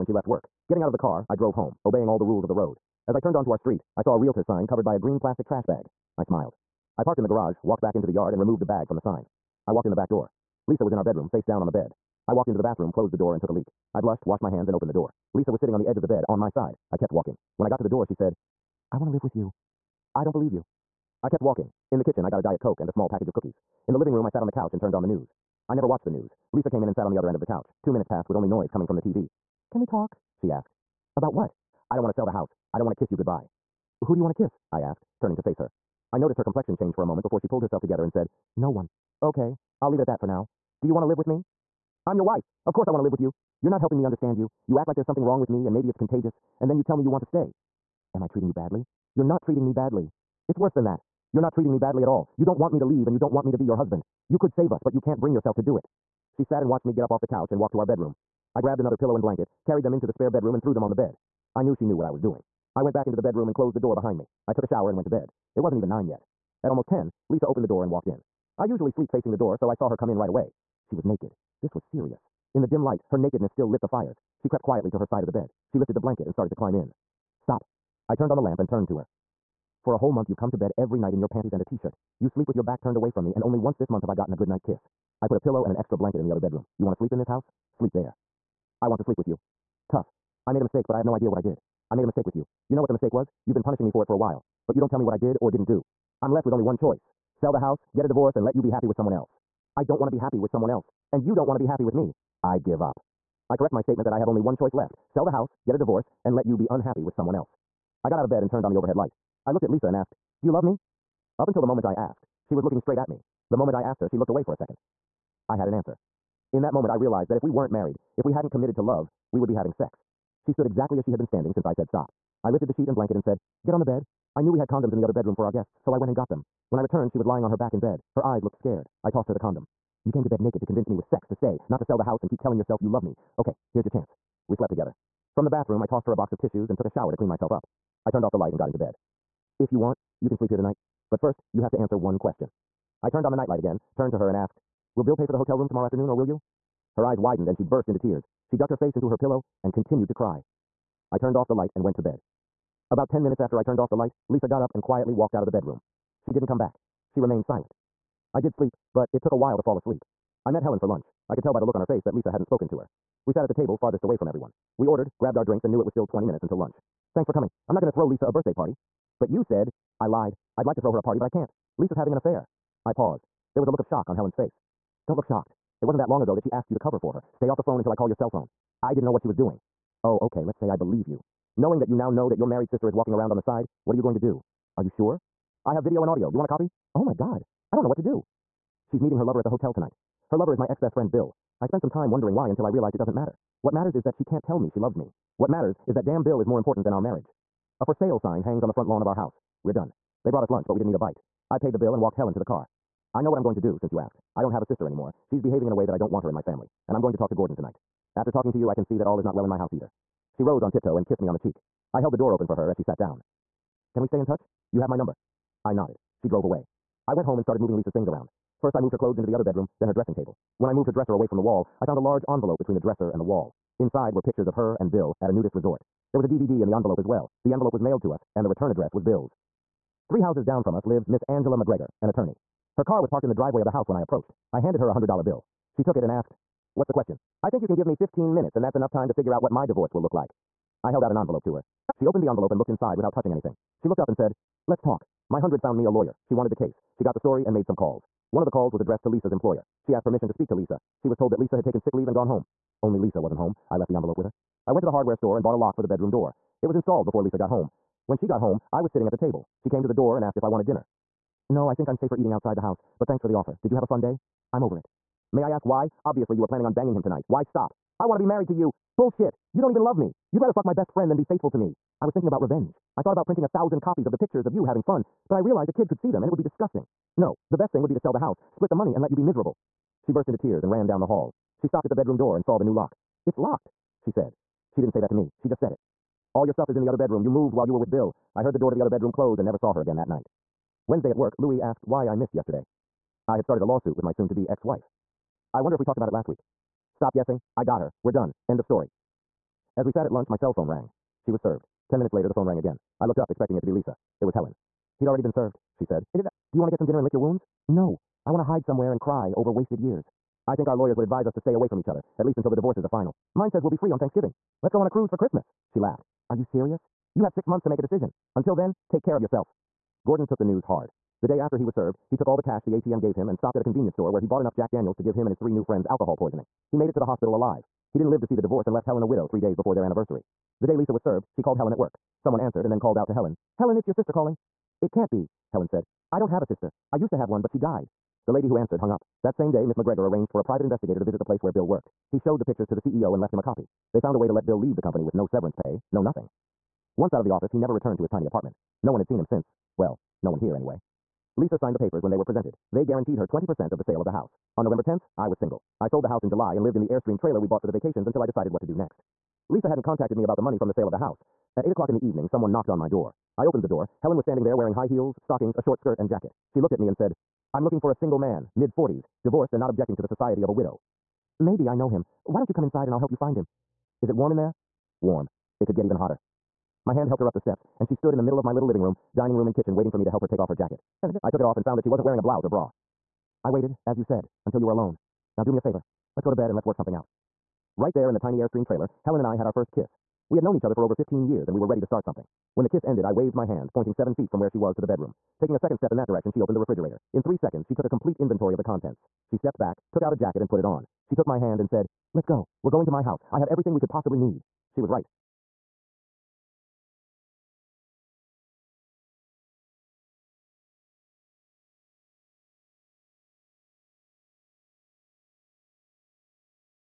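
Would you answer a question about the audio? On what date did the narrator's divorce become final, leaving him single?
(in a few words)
November 10th.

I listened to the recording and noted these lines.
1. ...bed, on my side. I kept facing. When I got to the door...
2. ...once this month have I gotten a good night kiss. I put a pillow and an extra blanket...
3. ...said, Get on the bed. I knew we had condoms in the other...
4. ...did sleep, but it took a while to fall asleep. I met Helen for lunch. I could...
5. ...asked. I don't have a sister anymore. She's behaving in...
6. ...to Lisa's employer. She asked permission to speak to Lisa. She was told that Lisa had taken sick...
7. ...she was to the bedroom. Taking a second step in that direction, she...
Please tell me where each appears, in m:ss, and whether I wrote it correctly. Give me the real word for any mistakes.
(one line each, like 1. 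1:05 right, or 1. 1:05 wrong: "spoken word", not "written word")
1. 0:16 wrong: "walking", not "facing"
2. 1:23 right
3. 2:03 right
4. 2:38 right
5. 3:23 right
6. 4:09 right
7. 6:34 right.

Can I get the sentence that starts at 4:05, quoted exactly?
My hundred found me a lawyer.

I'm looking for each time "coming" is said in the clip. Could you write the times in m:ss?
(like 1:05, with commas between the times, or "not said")
0:28, 2:47.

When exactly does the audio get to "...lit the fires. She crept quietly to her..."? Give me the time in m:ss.
1:13.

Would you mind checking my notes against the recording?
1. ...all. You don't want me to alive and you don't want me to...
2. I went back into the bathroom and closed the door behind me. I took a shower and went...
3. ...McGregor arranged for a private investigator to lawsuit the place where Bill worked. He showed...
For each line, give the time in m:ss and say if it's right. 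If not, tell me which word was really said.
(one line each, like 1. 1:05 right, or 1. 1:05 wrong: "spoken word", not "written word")
1. 0:52 wrong: "leave", not "alive"
2. 1:02 wrong: "bedroom", not "bathroom"
3. 5:39 wrong: "visit", not "lawsuit".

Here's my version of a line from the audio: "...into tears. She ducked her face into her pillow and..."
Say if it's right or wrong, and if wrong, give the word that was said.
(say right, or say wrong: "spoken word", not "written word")
right.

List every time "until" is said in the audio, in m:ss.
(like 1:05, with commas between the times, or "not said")
1:51, 2:46, 2:57, 3:12, 5:12, 5:18, 5:58, 6:24.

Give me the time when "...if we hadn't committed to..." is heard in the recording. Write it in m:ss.
1:58.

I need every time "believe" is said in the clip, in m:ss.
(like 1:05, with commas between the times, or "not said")
0:20, 3:00.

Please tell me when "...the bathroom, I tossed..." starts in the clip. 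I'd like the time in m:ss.
2:15.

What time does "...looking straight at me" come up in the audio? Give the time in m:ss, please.
1:52.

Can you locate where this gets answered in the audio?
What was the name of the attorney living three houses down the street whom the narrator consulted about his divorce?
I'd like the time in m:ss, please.
3:51.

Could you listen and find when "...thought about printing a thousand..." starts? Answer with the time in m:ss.
4:33.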